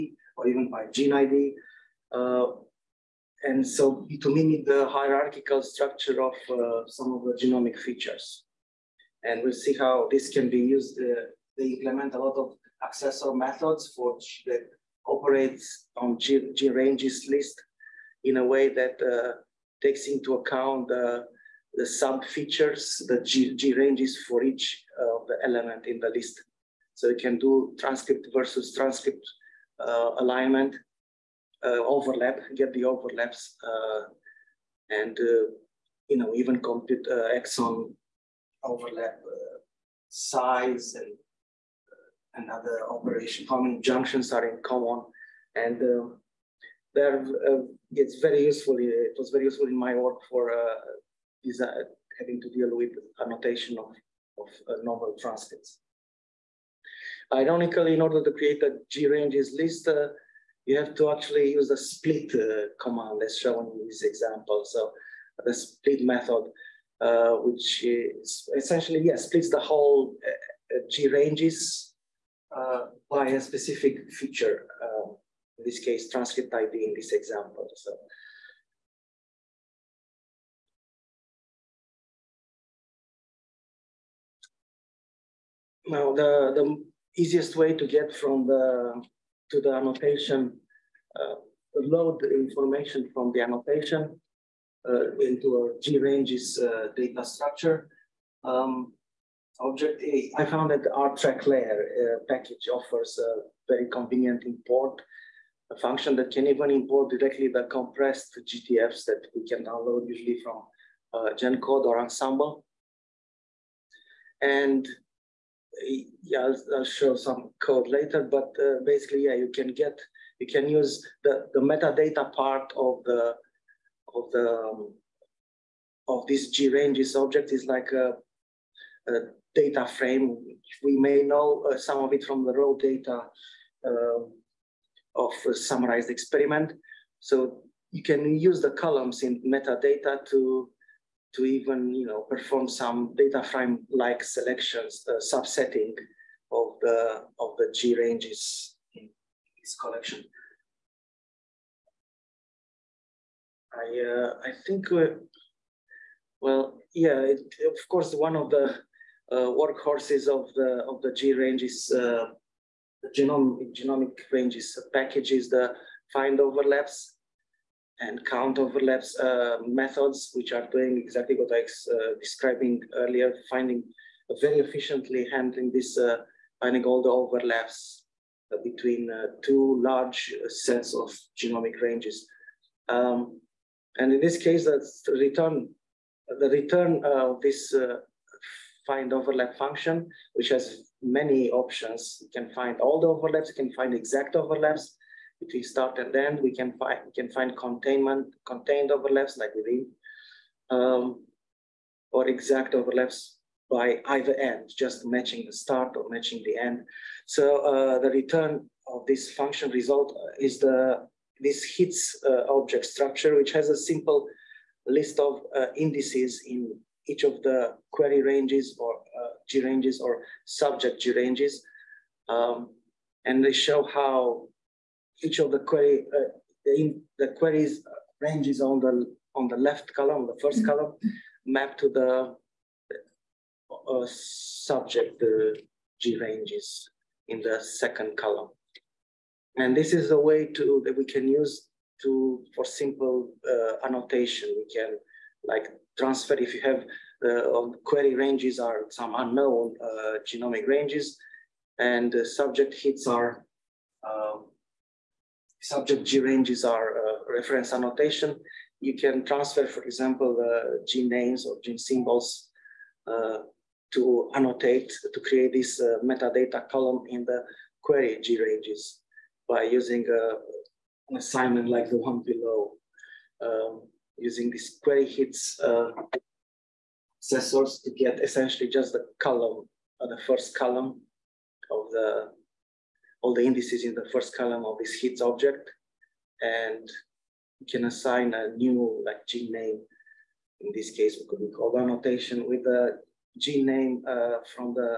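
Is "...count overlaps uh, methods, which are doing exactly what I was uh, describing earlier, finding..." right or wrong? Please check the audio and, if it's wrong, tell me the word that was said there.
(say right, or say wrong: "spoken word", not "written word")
right.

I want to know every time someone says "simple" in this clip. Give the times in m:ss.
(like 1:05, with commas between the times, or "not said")
3:33, 4:02.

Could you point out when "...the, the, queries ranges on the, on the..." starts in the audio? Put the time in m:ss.
3:46.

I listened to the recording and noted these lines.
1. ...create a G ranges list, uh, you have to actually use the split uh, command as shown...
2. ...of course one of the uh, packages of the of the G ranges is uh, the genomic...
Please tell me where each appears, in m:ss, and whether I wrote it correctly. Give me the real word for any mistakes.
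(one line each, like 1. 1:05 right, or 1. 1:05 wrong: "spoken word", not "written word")
1. 0:58 right
2. 2:37 wrong: "workhorses", not "packages".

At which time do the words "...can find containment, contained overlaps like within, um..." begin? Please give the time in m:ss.
3:17.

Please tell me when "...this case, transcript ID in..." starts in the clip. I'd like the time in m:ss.
1:15.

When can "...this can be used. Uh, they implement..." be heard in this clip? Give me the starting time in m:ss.
0:10.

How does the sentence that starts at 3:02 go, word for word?
Um, and in this case, that's the return, the return of this find overlap function, which has many options.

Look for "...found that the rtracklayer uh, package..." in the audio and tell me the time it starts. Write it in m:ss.
1:40.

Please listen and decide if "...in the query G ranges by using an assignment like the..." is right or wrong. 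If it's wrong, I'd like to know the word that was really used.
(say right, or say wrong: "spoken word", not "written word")
right.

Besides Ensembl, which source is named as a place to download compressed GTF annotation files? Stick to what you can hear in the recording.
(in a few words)
GenCode.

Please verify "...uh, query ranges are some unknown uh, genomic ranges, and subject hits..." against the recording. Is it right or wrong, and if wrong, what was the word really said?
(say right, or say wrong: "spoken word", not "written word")
right.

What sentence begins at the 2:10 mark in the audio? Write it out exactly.
We may know uh, some of it from the raw data um, of summarized experiment.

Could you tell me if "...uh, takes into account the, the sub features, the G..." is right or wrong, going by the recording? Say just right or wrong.
right.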